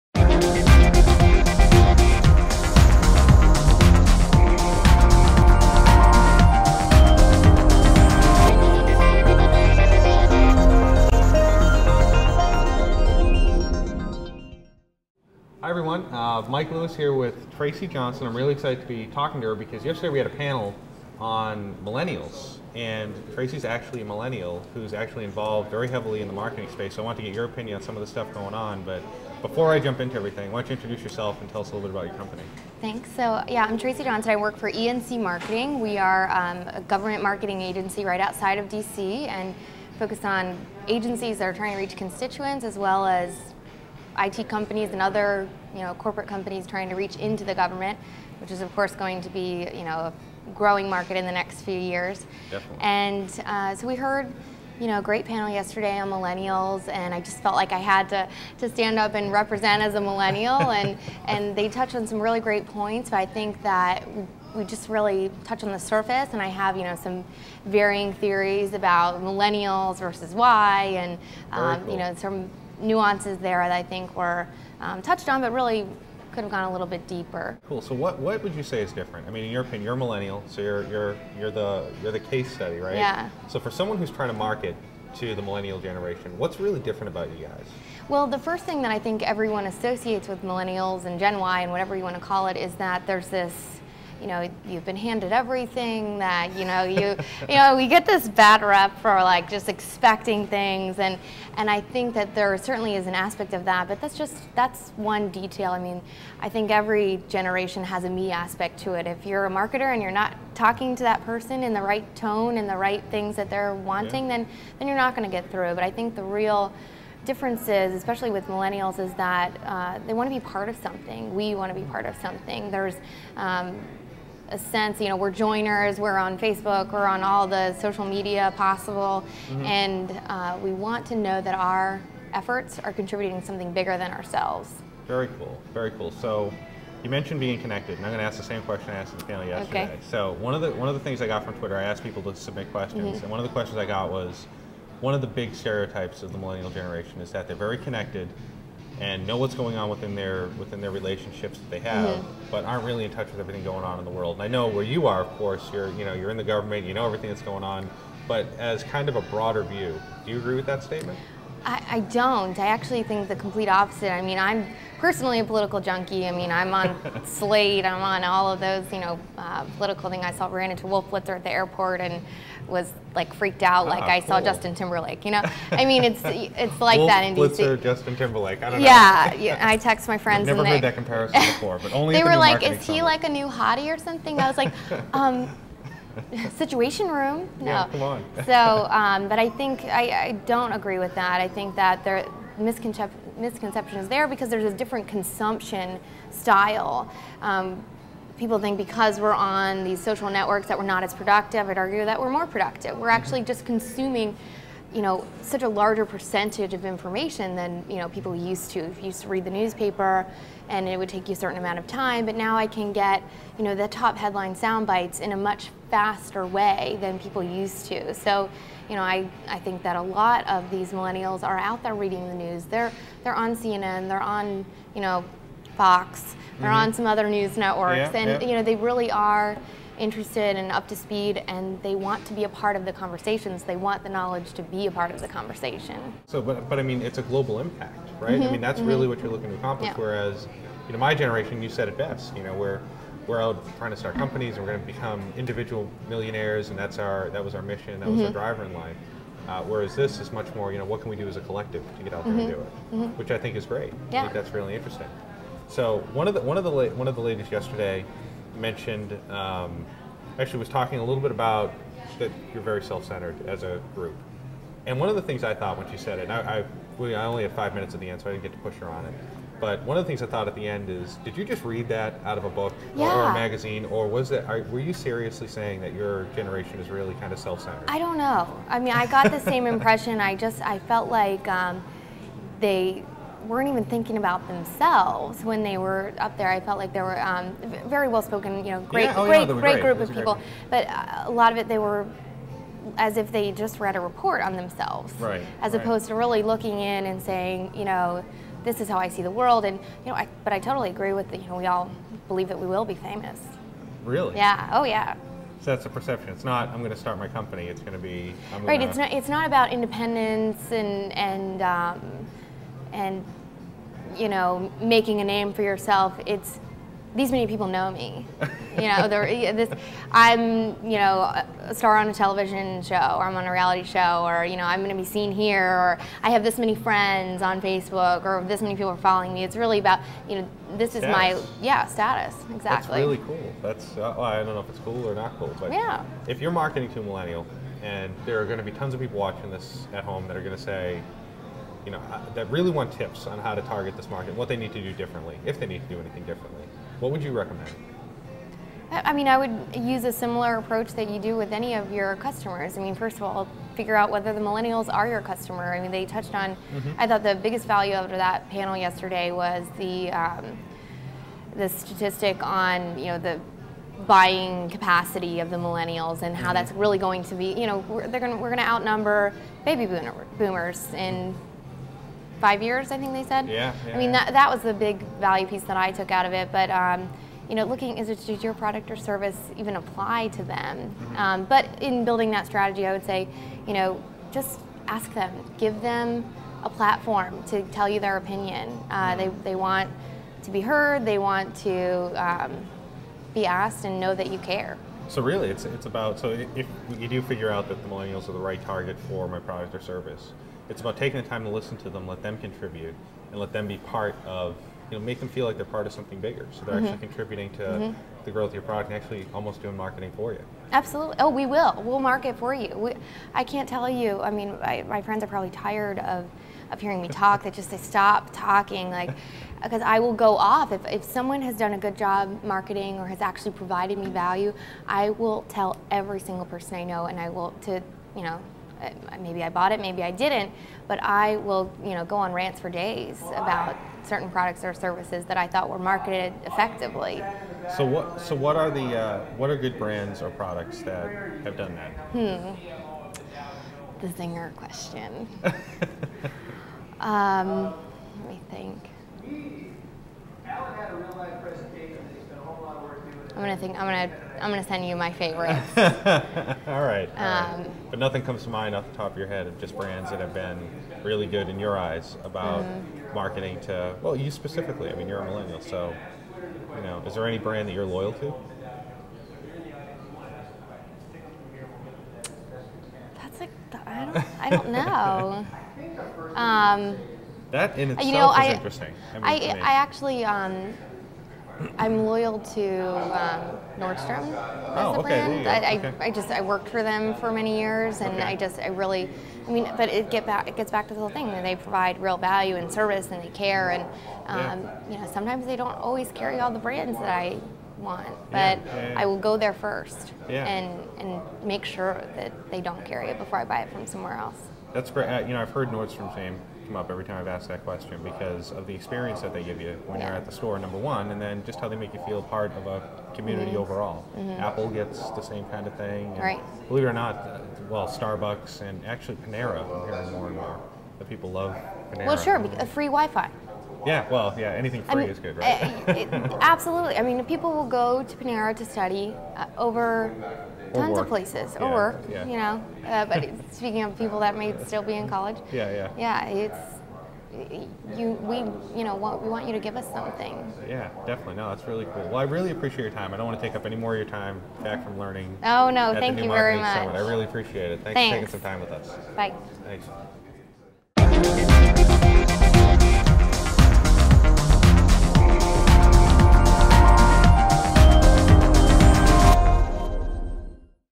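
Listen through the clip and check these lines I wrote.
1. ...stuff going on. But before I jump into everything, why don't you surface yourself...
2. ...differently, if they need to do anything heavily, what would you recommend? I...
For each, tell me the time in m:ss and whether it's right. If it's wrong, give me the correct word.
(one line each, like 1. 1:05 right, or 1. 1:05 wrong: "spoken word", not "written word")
1. 0:28 wrong: "introduce", not "surface"
2. 5:44 wrong: "differently", not "heavily".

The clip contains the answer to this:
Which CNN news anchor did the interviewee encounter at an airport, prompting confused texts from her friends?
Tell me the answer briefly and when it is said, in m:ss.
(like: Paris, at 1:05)
Wolf Blitzer, at 2:50.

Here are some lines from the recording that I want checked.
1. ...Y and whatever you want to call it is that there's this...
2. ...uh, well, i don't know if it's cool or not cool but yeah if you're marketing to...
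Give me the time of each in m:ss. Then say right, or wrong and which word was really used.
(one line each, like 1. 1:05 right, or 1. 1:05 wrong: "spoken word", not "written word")
1. 1:31 right
2. 5:33 right.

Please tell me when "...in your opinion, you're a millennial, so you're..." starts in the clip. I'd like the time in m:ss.
1:19.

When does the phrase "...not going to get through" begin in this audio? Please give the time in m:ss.
1:54.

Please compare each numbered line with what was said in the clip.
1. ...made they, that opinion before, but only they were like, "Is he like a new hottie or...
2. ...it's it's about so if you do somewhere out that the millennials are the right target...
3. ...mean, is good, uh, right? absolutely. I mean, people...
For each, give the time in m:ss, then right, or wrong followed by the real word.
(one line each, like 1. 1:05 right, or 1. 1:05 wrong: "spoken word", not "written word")
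1. 3:00 wrong: "comparison", not "opinion"
2. 6:35 wrong: "figure", not "somewhere"
3. 8:45 right.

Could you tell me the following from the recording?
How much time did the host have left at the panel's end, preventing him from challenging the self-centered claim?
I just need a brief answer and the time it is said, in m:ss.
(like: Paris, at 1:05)
5 minutes, at 4:27.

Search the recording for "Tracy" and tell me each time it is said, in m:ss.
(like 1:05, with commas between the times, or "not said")
0:17, 0:23, 0:33.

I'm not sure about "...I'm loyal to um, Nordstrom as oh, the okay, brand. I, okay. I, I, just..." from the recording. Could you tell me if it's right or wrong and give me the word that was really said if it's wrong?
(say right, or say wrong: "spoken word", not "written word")
right.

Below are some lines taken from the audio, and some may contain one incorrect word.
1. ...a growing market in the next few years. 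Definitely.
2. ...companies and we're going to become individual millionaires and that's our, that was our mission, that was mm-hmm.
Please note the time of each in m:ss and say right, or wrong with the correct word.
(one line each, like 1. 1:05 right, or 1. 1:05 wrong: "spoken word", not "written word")
1. 0:50 right
2. 4:04 right.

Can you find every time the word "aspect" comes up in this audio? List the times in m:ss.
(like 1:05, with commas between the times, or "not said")
1:43, 1:48.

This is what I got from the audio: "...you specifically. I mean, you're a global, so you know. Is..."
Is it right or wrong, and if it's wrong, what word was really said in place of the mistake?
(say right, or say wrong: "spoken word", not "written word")
wrong: "millennial", not "global".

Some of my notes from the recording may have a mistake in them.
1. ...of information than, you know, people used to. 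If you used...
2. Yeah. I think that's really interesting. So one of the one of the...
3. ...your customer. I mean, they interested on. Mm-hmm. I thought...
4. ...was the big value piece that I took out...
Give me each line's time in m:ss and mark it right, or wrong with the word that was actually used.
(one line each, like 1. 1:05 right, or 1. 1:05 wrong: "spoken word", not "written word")
1. 3:26 right
2. 4:14 right
3. 5:55 wrong: "touched", not "interested"
4. 6:14 right.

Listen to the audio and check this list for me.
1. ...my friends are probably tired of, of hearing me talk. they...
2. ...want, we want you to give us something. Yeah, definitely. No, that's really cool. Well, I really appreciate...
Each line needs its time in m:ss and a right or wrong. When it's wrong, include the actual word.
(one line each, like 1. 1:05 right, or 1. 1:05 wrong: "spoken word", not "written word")
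1. 6:54 right
2. 8:58 right.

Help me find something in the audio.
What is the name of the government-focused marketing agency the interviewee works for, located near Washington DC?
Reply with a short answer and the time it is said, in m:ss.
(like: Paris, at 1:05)
ENC Marketing, at 0:34.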